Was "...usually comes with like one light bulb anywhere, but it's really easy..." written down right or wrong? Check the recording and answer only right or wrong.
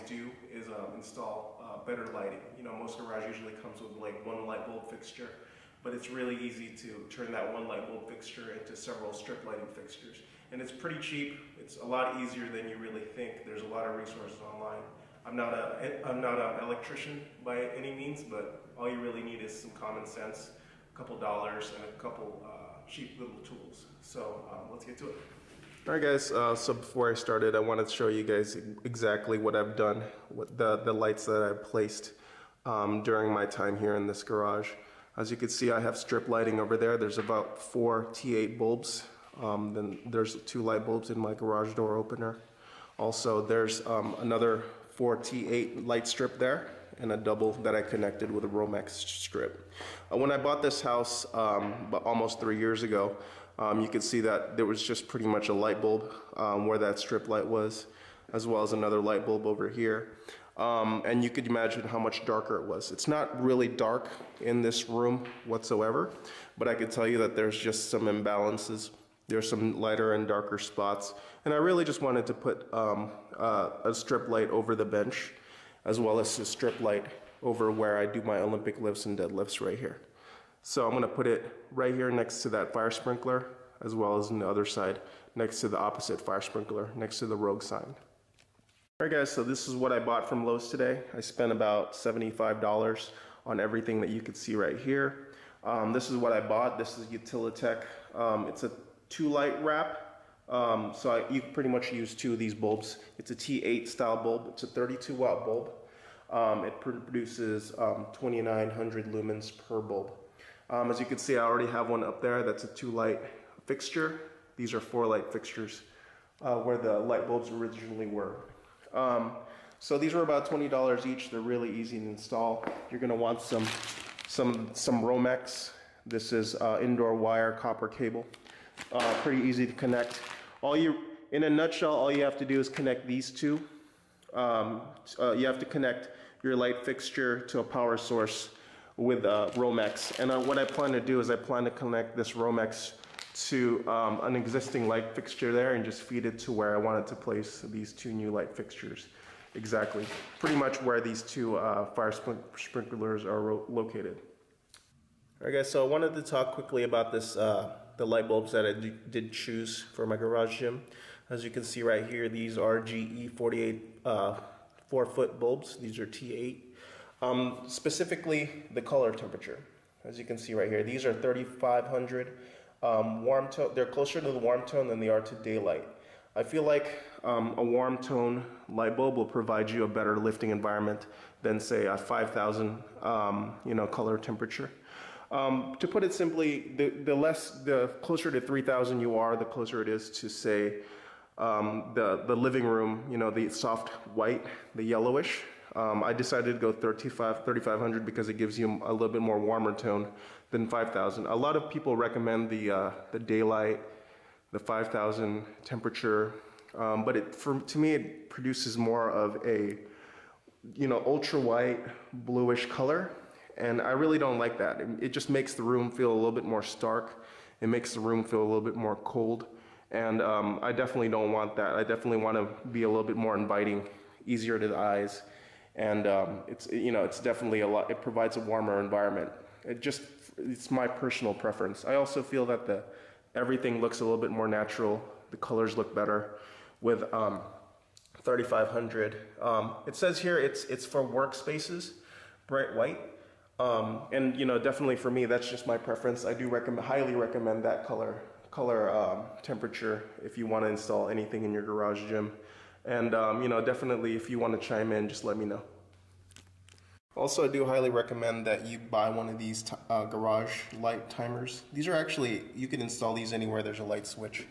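wrong.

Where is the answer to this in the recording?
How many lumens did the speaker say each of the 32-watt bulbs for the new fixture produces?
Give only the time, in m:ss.
1:48.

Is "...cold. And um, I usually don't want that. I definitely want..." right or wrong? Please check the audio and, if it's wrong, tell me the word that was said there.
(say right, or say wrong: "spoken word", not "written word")
wrong: "definitely", not "usually".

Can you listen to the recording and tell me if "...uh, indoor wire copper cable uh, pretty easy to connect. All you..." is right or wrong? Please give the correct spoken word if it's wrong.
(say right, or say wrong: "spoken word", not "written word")
right.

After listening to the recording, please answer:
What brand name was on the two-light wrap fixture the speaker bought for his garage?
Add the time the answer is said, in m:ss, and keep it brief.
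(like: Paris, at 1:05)
Utilitech, at 1:37.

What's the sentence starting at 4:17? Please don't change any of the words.
Also, I do highly recommend that you buy one of these uh, garage light timers.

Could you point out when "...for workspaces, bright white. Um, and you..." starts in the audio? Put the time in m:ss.
4:00.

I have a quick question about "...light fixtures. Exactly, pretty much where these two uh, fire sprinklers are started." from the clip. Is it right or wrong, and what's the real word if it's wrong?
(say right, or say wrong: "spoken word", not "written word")
wrong: "located", not "started".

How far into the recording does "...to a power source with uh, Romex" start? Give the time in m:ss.
2:17.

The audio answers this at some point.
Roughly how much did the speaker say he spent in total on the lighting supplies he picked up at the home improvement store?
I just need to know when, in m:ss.
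1:31.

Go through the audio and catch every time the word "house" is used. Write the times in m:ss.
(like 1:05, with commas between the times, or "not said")
0:50.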